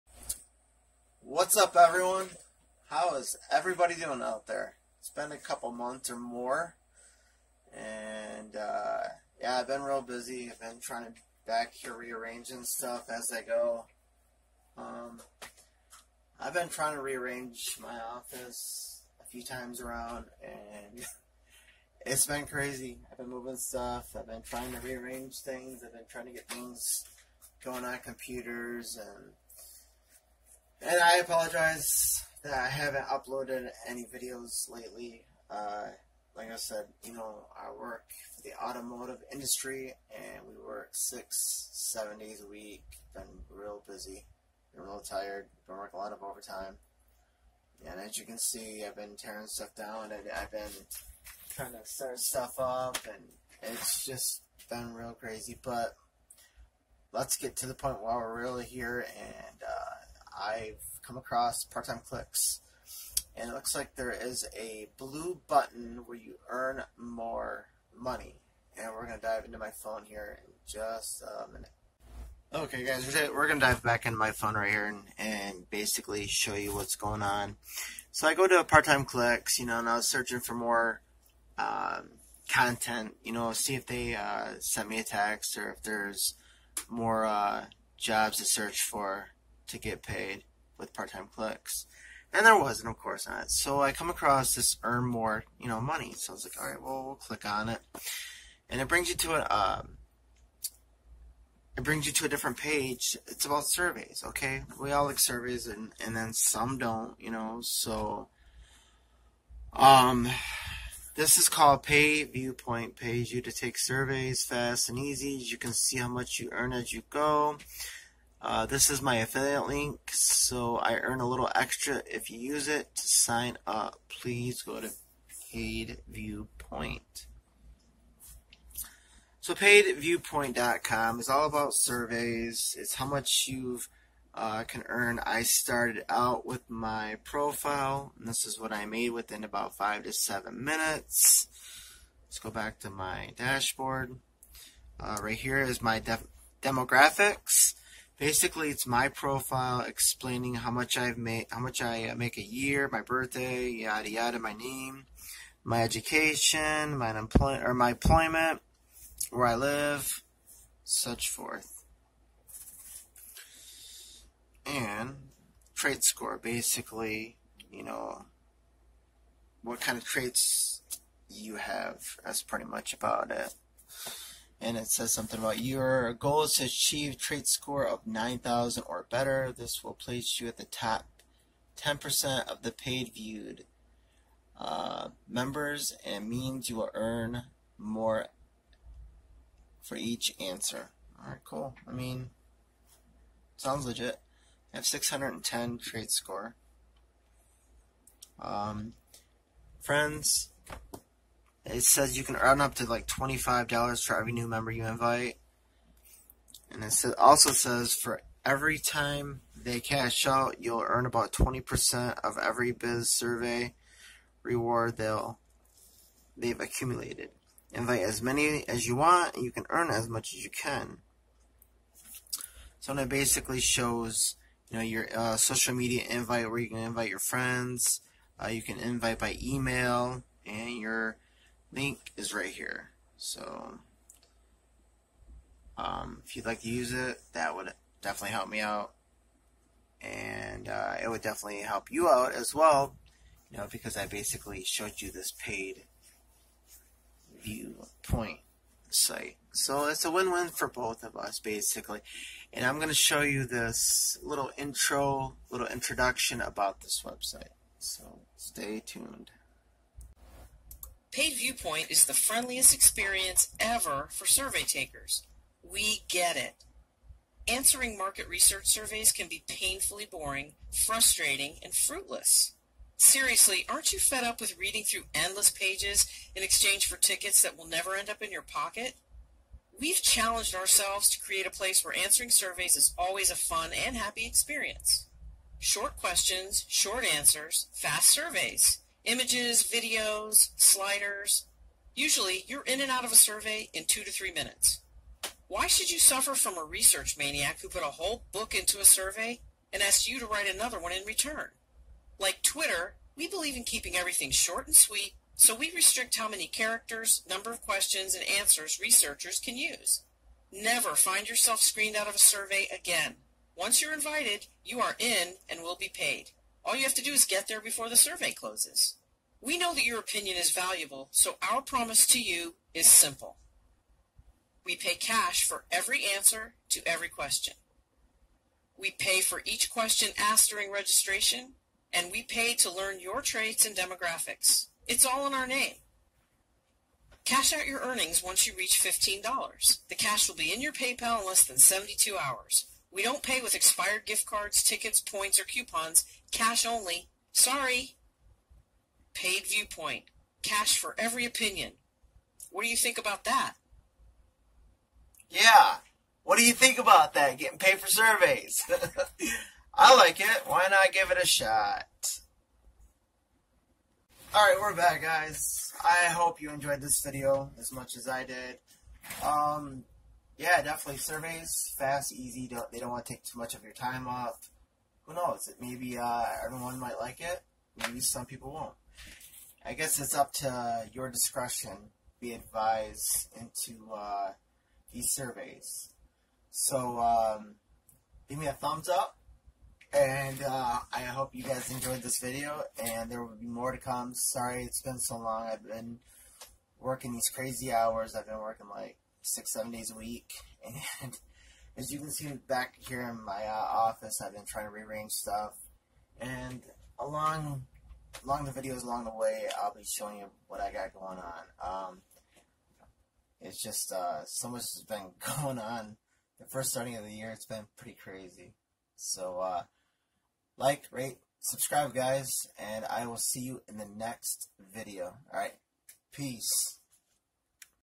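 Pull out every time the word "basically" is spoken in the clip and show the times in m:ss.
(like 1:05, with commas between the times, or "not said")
1:15, 2:28, 2:46, 3:43, 4:04, 4:11.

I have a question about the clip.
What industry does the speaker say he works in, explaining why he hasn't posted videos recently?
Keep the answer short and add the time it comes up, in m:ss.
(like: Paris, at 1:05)
automotive industry, at 0:38.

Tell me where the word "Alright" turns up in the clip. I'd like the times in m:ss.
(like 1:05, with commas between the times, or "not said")
3:11, 6:04.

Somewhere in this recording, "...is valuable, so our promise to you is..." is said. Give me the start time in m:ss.
5:20.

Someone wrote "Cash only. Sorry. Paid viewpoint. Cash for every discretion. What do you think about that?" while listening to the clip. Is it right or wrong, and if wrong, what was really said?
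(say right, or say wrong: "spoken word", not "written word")
wrong: "opinion", not "discretion".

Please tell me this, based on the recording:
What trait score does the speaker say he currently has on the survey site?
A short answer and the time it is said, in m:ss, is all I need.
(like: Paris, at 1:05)
610, at 3:14.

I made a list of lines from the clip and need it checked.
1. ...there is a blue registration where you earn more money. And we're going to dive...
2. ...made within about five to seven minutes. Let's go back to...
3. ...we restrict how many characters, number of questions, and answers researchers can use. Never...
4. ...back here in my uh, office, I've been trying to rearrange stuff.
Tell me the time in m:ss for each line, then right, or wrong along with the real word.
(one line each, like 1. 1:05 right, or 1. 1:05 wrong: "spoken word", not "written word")
1. 1:03 wrong: "button", not "registration"
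2. 2:18 right
3. 5:05 right
4. 6:42 right.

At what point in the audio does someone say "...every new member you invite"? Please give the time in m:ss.
3:24.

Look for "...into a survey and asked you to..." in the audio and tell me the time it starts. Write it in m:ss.
4:58.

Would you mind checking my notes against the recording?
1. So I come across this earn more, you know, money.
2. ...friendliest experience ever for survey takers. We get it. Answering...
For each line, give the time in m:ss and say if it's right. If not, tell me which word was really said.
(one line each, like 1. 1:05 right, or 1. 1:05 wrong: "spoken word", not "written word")
1. 1:33 right
2. 4:22 right.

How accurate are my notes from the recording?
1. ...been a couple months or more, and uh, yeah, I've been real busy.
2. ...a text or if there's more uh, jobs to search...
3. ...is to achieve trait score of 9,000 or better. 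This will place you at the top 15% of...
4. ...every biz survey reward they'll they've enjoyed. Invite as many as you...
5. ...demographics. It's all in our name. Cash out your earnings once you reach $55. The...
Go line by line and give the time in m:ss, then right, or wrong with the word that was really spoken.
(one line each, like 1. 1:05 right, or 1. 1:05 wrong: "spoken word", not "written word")
1. 0:05 right
2. 1:24 right
3. 2:56 wrong: "10", not "15"
4. 3:32 wrong: "accumulated", not "enjoyed"
5. 5:33 wrong: "15", not "55".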